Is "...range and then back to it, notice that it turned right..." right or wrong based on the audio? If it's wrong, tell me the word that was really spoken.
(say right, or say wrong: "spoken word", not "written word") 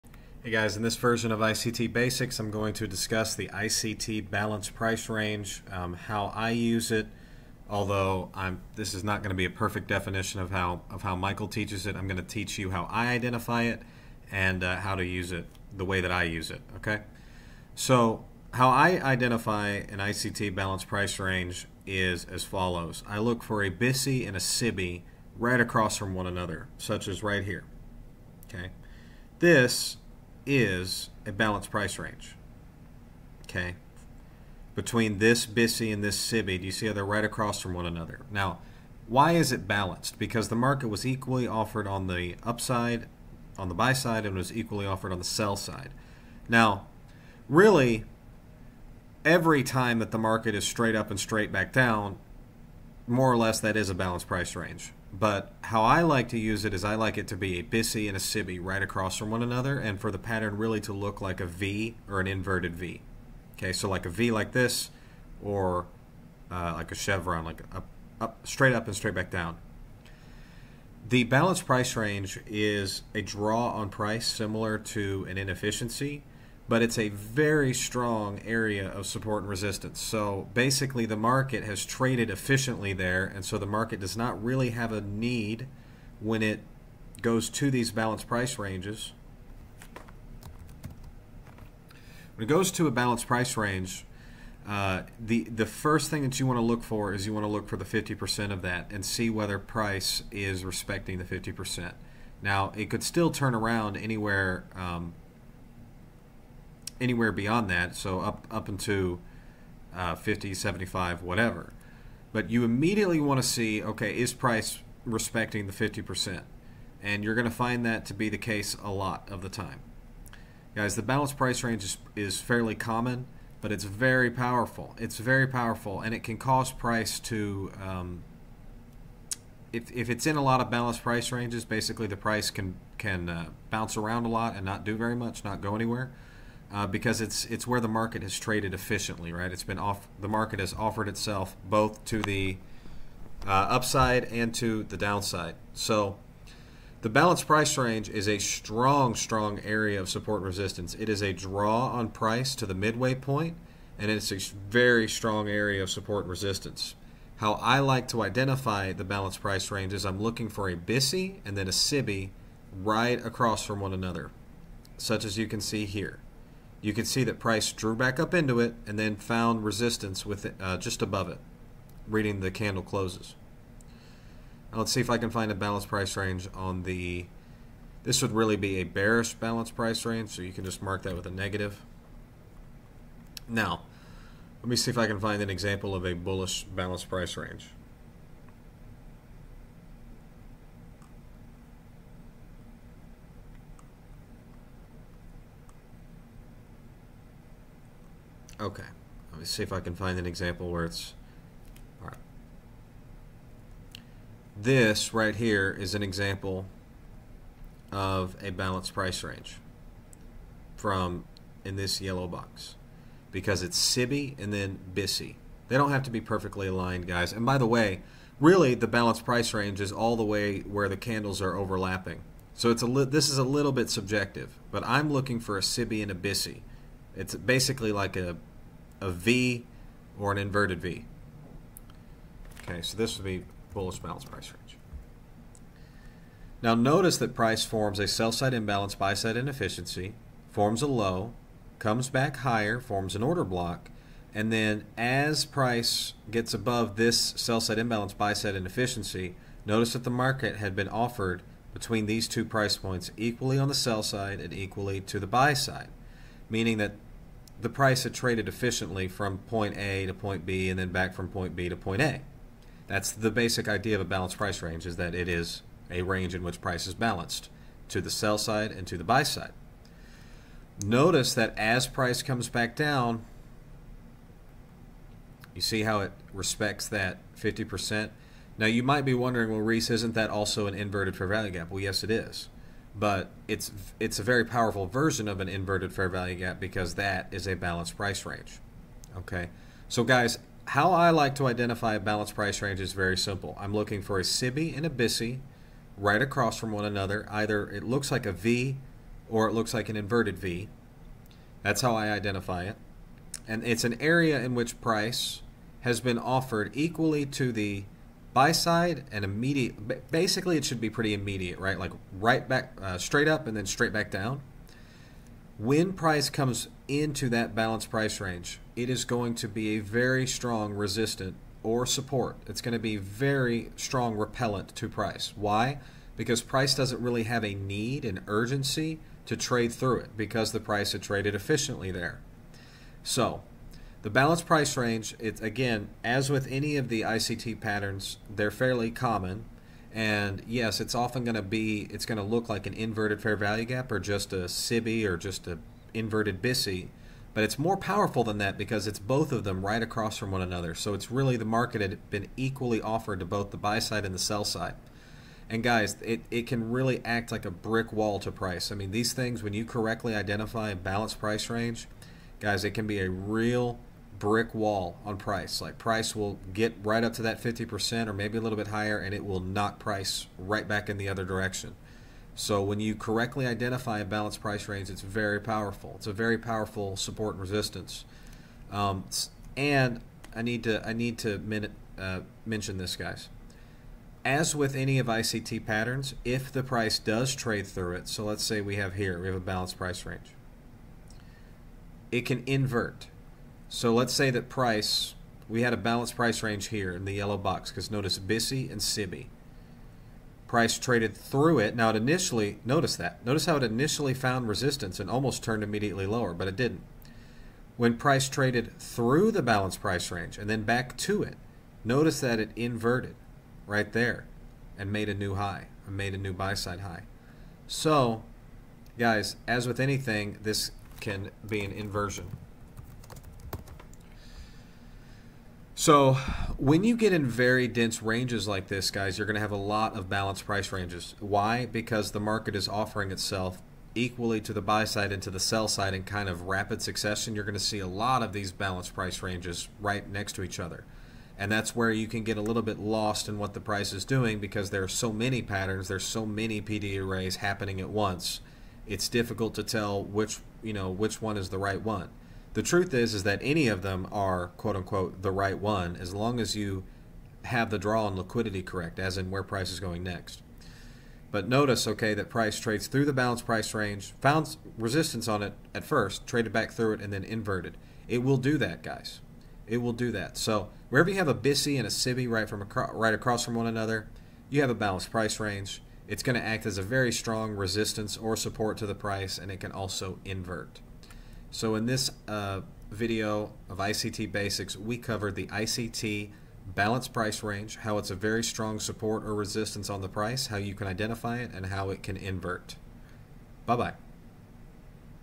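wrong: "inverted", not "turned".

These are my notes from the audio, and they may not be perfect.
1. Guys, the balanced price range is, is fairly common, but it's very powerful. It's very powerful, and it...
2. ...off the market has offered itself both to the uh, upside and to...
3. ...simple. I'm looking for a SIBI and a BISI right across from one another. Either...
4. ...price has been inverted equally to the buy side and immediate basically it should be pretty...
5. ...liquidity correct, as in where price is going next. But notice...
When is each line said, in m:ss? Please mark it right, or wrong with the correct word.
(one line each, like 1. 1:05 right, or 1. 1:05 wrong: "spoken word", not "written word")
1. 2:00 right
2. 2:19 right
3. 4:53 right
4. 5:04 wrong: "offered", not "inverted"
5. 7:38 right.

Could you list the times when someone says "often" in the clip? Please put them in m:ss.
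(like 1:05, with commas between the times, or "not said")
5:40.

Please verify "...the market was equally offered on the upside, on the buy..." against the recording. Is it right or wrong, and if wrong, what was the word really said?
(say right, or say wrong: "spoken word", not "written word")
right.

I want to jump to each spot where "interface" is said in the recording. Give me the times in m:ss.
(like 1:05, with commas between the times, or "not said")
not said.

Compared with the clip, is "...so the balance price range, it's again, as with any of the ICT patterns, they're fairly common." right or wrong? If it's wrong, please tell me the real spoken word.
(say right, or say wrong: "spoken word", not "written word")
right.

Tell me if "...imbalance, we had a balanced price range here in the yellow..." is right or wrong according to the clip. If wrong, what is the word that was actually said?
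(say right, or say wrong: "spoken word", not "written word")
wrong: "price", not "imbalance".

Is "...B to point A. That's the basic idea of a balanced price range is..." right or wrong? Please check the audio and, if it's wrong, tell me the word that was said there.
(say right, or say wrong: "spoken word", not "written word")
right.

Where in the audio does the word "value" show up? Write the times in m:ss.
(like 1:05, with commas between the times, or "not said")
4:41, 4:46, 5:43.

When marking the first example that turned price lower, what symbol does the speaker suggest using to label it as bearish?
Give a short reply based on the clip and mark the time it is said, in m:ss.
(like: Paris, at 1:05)
a negative, at 3:01.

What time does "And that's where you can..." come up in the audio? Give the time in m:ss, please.
7:21.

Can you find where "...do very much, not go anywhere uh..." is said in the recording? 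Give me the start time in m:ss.
2:14.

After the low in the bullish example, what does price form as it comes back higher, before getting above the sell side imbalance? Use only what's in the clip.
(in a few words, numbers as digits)
an order block.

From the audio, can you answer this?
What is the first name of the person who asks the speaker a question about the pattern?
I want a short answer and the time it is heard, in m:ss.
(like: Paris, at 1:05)
Reece, at 4:39.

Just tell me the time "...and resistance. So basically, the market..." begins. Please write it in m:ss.
1:19.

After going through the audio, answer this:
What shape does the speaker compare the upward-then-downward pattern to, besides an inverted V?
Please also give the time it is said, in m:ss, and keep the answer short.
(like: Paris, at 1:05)
a chevron, at 1:06.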